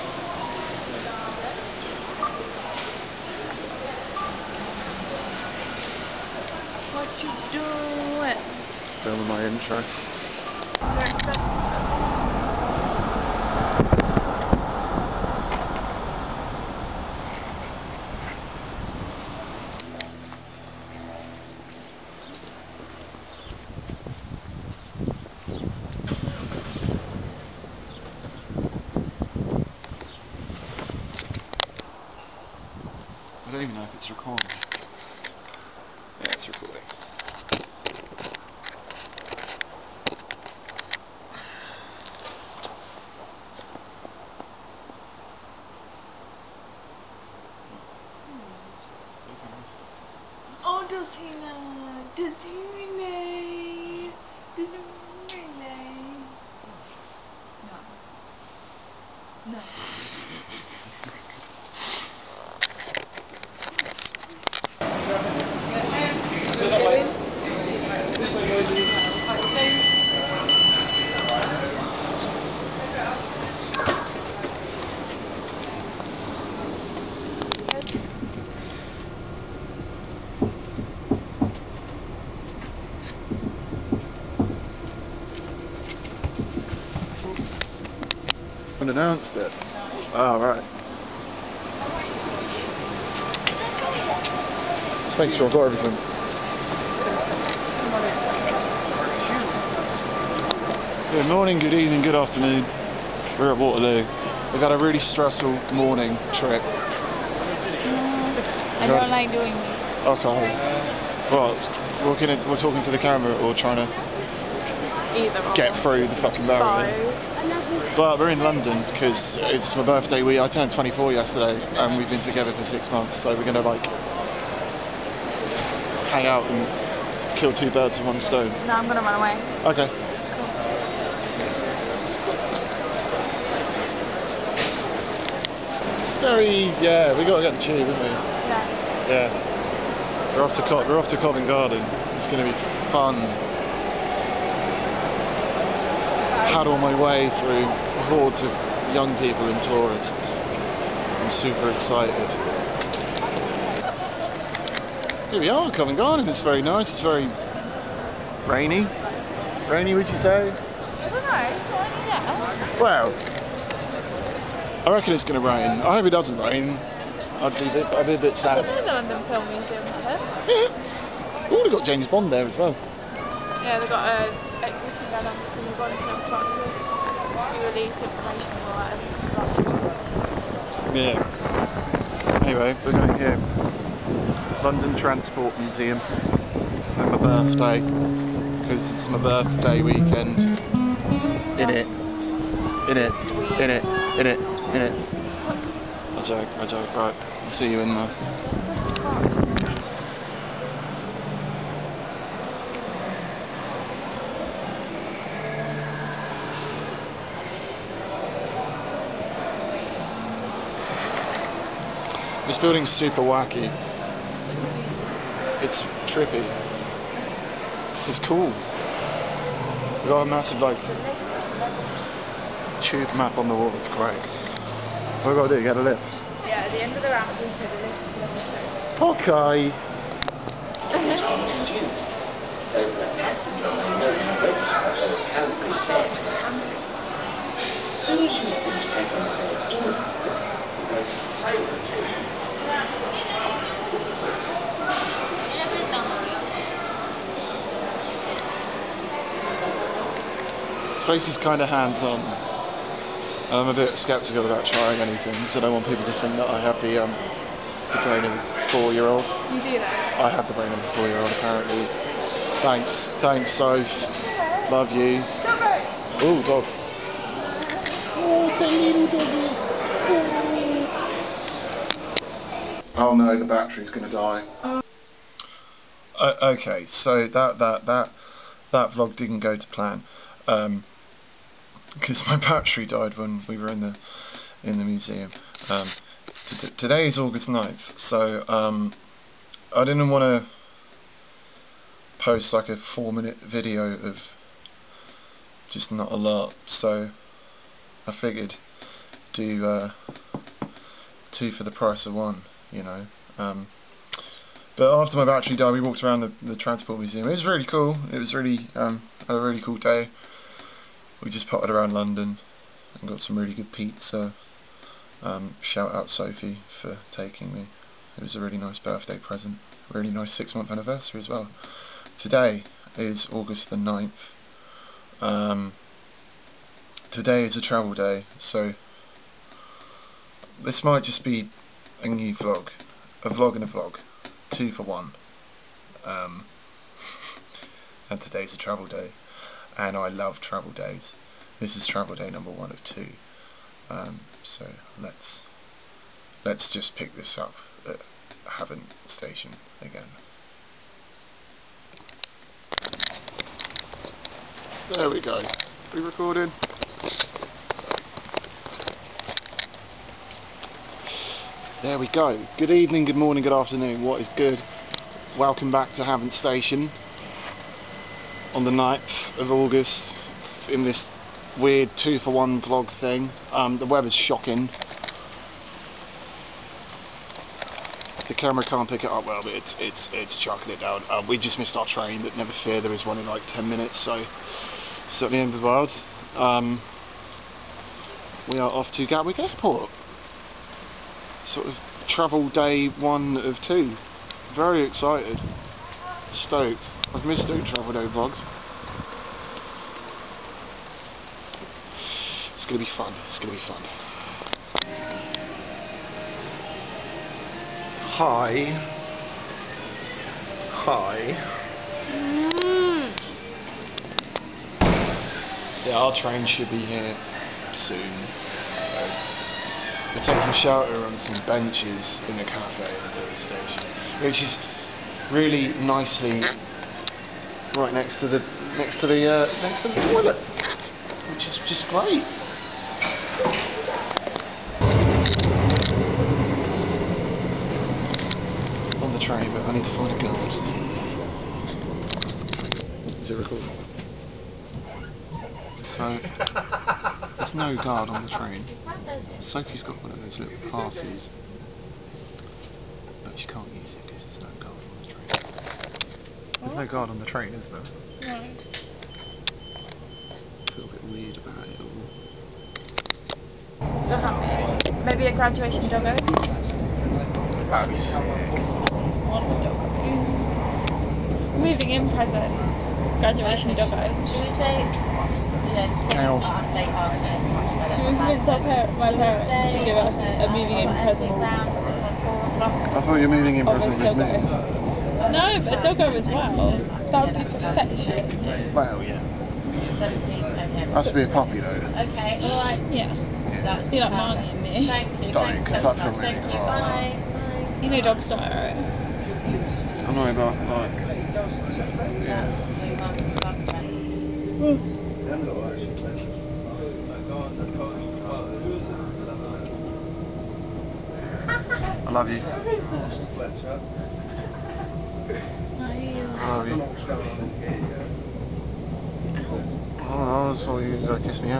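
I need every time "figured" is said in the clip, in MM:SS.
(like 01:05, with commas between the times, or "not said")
04:58.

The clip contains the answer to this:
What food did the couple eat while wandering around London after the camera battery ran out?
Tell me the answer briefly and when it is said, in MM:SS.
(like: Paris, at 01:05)
Pizza, at 05:13.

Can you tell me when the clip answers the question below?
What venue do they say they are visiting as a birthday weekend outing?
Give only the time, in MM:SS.
03:04.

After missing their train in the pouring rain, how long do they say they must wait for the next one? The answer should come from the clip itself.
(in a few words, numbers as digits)
10 minutes.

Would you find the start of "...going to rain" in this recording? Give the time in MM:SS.
02:45.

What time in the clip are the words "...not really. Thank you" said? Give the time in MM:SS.
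08:15.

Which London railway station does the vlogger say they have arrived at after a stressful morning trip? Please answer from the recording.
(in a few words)
Waterloo.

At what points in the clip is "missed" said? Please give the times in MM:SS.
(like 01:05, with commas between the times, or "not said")
06:21, 06:37.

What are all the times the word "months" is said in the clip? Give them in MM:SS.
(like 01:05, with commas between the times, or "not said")
02:02, 05:20.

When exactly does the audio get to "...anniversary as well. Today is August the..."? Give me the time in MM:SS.
05:20.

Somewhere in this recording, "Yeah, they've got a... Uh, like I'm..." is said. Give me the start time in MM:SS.
02:52.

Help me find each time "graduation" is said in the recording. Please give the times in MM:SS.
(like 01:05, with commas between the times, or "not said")
07:45, 07:53.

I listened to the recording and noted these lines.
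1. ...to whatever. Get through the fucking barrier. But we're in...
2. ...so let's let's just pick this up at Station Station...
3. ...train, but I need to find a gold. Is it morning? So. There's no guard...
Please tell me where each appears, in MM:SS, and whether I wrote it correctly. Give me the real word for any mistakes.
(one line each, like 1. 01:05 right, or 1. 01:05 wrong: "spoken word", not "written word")
1. 01:53 wrong: "either", not "whatever"
2. 05:44 wrong: "Havant", not "Station"
3. 07:19 wrong: "recording", not "morning".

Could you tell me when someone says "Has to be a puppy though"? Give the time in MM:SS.
08:10.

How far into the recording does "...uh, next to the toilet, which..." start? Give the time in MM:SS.
07:09.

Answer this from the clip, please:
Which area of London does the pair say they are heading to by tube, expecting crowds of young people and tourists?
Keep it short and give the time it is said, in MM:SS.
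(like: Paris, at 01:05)
Covent Garden, at 02:21.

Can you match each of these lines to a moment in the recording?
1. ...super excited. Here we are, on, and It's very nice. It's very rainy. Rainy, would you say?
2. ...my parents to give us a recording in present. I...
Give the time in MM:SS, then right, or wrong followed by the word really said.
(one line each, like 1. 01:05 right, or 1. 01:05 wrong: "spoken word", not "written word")
1. 02:31 right
2. 07:58 wrong: "moving", not "recording".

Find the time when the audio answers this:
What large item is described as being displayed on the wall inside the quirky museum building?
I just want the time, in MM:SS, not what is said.
03:42.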